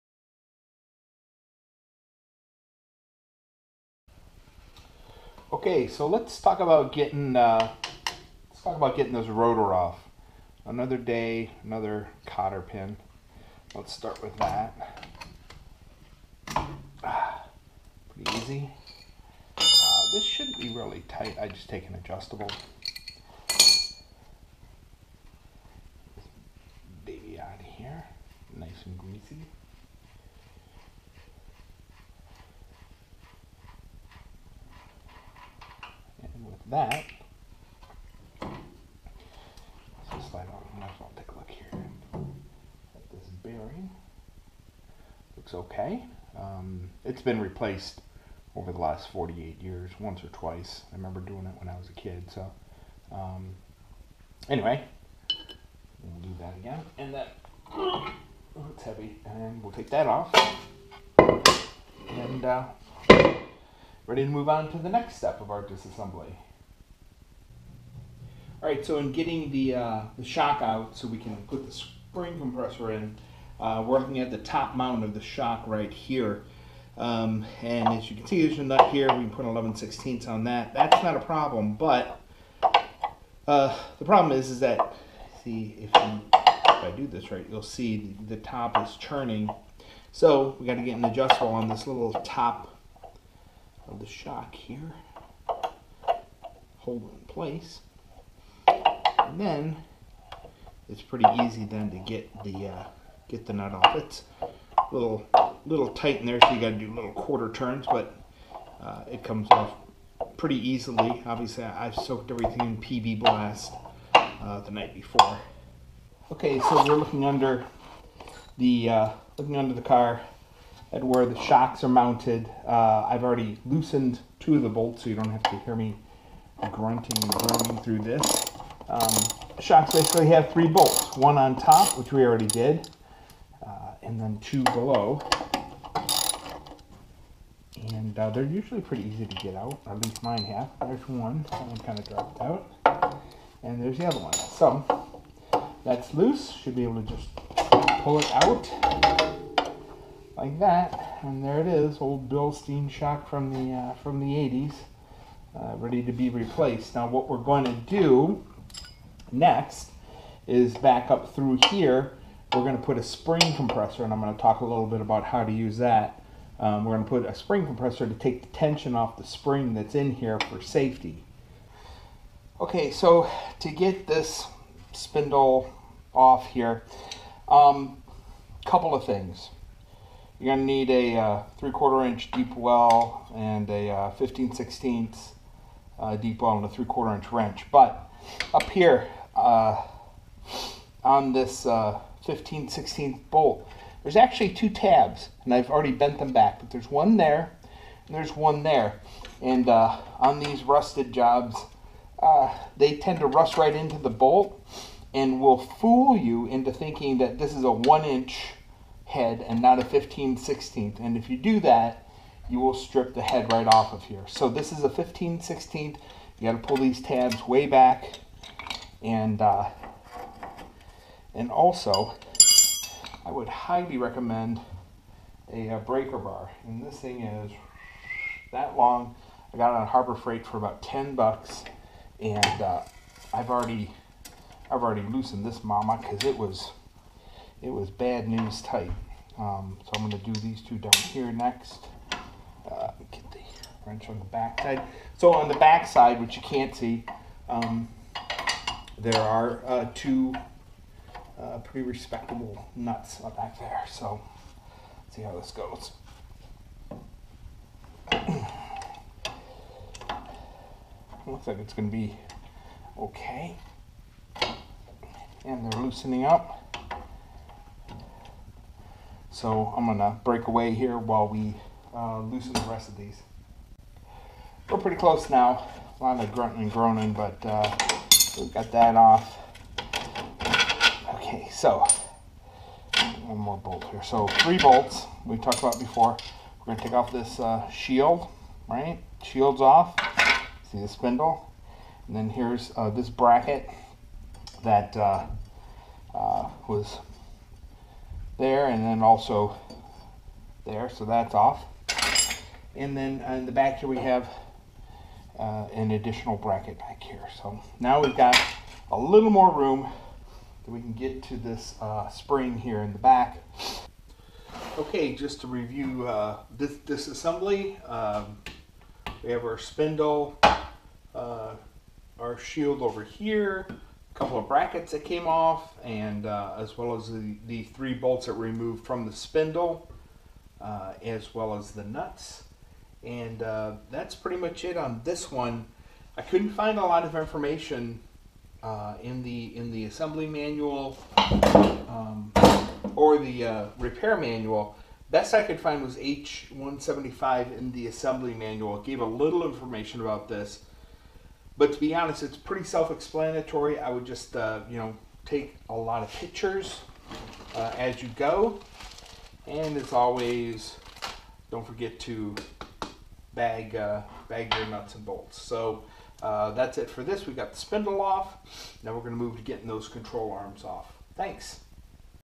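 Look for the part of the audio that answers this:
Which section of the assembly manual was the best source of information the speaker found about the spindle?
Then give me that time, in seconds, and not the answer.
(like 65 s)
345 s.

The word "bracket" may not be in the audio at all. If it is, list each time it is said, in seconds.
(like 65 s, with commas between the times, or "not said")
293 s, 306 s, 324 s.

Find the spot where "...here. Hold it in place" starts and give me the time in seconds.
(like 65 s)
94 s.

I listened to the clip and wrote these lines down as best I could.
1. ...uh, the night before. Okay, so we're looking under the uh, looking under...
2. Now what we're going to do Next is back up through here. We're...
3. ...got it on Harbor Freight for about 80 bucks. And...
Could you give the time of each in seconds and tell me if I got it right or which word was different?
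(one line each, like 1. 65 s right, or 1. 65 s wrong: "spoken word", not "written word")
1. 114 s right
2. 156 s right
3. 229 s wrong: "10", not "80".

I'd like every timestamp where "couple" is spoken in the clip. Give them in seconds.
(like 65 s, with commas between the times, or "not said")
178 s, 324 s.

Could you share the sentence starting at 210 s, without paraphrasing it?
And if you do that, you will strip the head right off of here.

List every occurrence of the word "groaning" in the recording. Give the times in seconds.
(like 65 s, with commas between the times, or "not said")
127 s, 276 s.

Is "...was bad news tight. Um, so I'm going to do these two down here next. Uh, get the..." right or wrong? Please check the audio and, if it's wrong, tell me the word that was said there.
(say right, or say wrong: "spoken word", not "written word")
right.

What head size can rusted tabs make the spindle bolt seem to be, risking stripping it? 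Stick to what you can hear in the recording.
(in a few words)
1 inch.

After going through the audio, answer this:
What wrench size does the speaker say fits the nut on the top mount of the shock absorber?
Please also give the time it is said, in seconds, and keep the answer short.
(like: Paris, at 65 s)
11/16, at 79 s.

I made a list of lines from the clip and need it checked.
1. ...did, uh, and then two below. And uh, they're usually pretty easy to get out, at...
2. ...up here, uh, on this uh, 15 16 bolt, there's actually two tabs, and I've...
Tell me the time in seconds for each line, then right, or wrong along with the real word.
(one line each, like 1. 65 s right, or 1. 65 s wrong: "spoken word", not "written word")
1. 132 s right
2. 188 s right.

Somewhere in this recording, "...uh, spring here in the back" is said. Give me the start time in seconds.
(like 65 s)
311 s.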